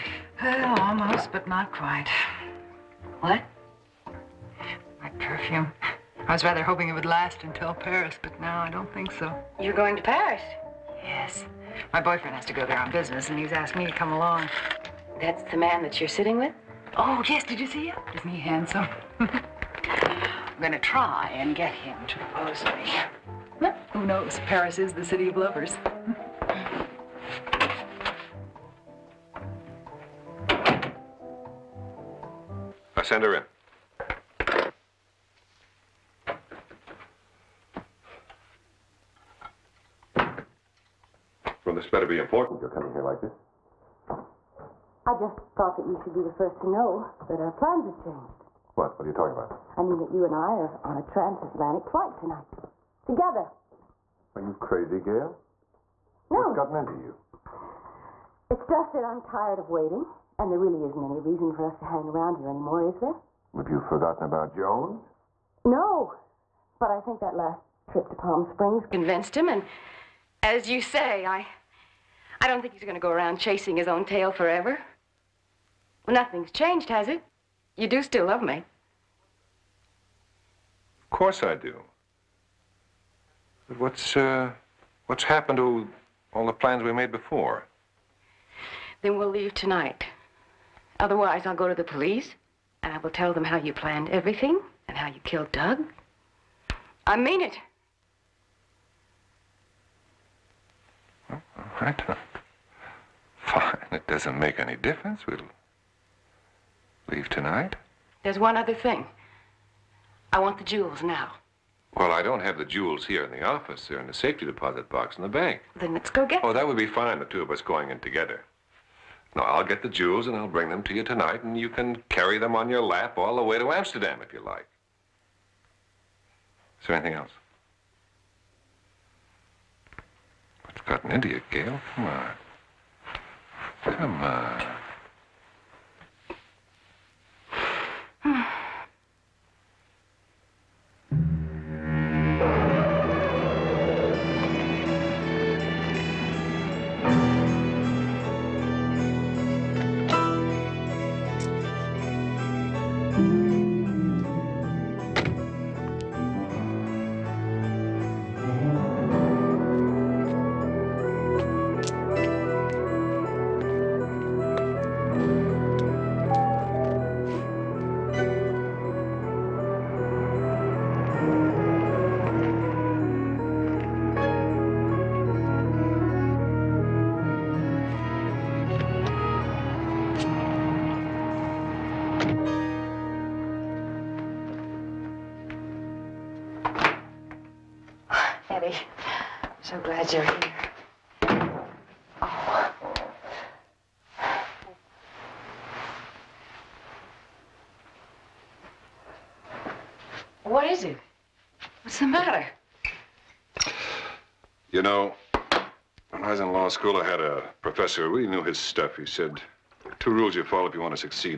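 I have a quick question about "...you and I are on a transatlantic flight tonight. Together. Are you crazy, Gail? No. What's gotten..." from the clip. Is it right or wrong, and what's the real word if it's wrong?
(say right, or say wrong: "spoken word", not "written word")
right.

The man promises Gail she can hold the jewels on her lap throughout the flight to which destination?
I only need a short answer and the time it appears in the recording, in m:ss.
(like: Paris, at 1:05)
Amsterdam, at 2:03.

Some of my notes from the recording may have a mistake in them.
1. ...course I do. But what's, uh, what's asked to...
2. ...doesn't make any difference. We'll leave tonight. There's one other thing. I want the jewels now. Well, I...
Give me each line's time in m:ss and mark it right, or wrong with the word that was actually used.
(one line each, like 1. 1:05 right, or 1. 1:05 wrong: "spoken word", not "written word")
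1. 1:21 wrong: "happened", not "asked"
2. 1:44 right.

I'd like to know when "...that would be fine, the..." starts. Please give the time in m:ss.
1:56.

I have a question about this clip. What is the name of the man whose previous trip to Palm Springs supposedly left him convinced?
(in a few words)
Jones.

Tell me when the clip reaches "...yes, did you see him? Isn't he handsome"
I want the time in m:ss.
0:17.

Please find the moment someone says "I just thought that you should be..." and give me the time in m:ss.
0:45.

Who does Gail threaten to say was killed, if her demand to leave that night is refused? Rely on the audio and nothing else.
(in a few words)
Doug.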